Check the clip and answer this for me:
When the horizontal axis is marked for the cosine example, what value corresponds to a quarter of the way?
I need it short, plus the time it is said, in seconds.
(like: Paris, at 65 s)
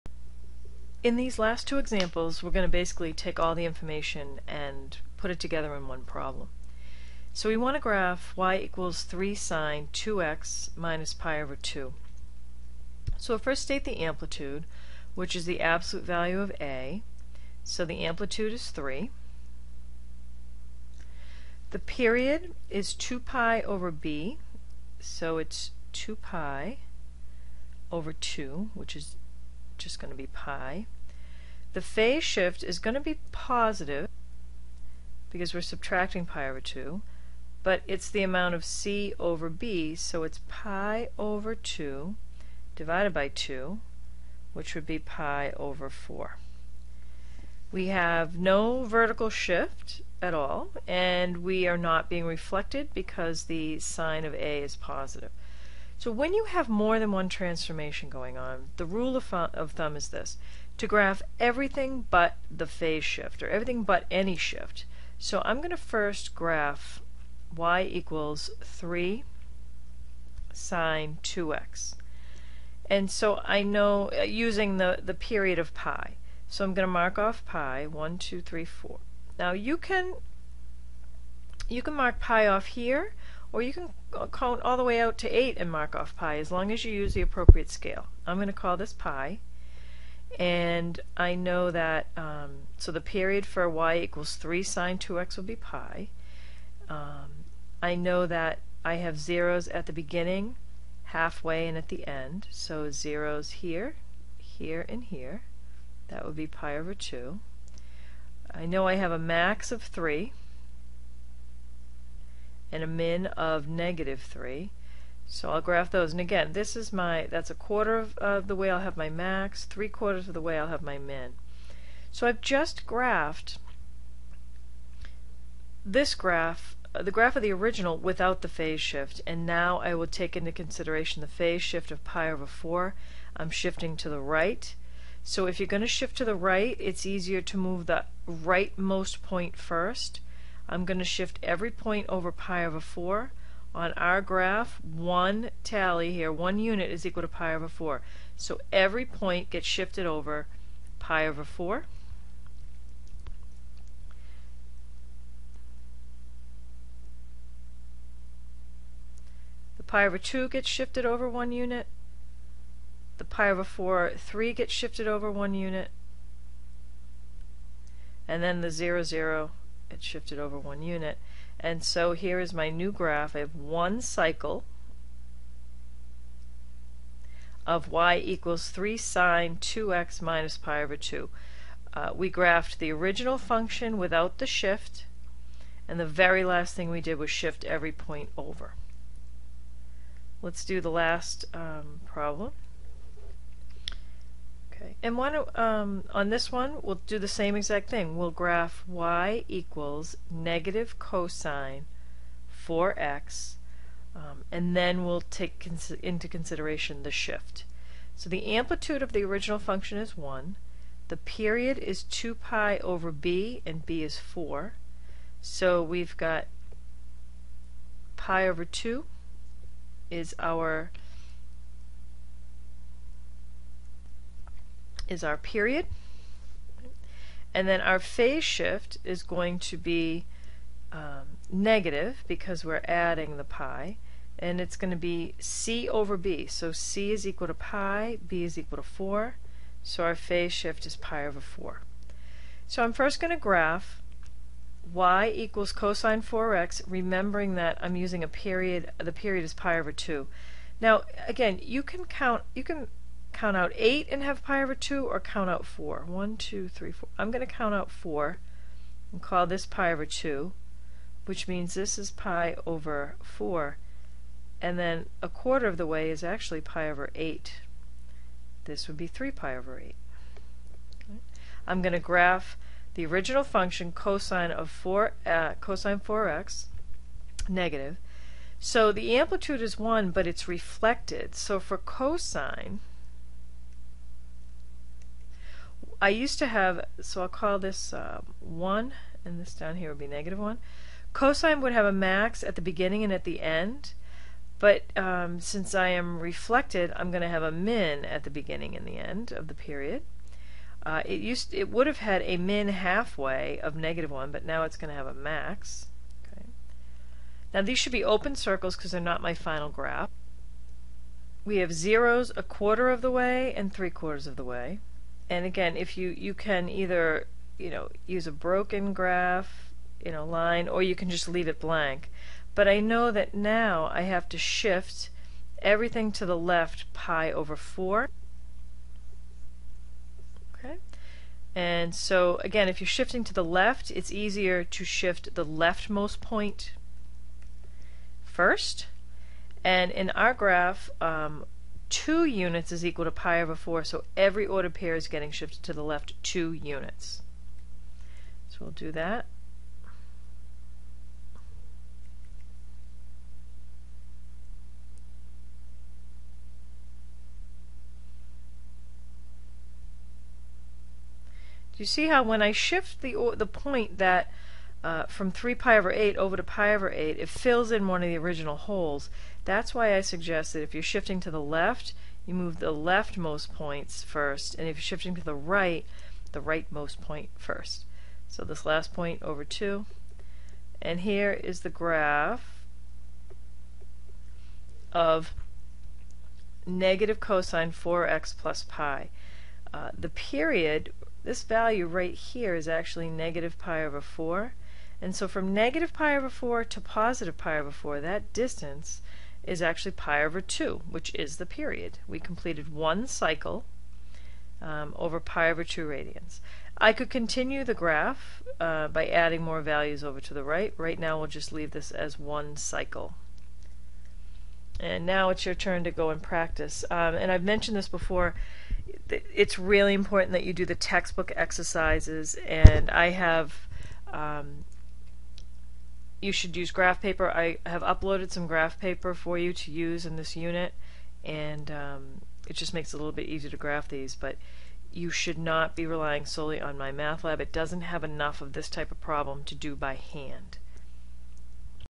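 pi over 8, at 265 s.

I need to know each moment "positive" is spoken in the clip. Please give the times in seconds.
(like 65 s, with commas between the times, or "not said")
33 s, 54 s, 396 s.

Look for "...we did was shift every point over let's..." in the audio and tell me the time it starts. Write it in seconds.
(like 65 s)
186 s.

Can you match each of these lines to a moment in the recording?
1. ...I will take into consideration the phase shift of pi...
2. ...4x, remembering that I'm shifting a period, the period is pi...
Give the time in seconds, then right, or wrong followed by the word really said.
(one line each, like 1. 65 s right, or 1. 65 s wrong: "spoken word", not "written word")
1. 129 s right
2. 246 s wrong: "using", not "shifting".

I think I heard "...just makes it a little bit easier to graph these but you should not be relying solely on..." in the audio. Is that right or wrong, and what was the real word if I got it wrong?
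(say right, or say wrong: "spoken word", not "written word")
right.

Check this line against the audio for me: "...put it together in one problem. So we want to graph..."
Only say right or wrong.
right.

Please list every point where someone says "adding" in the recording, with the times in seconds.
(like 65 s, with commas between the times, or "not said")
232 s, 409 s.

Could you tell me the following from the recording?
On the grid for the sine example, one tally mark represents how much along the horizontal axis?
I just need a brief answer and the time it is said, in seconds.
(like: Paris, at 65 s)
pi over 4, at 146 s.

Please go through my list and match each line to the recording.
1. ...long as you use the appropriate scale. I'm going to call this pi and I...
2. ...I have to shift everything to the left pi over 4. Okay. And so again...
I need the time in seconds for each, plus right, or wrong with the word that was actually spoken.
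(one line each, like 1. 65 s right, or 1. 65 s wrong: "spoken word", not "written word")
1. 86 s right
2. 323 s right.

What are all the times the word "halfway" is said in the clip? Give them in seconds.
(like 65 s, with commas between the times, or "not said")
101 s, 302 s.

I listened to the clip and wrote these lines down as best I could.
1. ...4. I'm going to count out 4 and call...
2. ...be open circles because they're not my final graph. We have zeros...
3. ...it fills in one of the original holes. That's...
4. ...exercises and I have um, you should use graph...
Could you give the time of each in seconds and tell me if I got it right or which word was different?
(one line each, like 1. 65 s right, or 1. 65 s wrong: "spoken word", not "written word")
1. 256 s right
2. 307 s right
3. 367 s right
4. 421 s right.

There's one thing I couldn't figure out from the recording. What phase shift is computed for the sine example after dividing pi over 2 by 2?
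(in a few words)
pi over 4.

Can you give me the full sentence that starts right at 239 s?
So our phase shift is pi over 4.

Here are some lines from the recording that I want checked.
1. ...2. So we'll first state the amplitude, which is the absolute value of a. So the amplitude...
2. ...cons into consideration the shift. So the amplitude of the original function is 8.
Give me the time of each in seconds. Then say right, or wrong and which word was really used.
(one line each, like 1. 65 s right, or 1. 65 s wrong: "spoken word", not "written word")
1. 11 s right
2. 205 s wrong: "1", not "8".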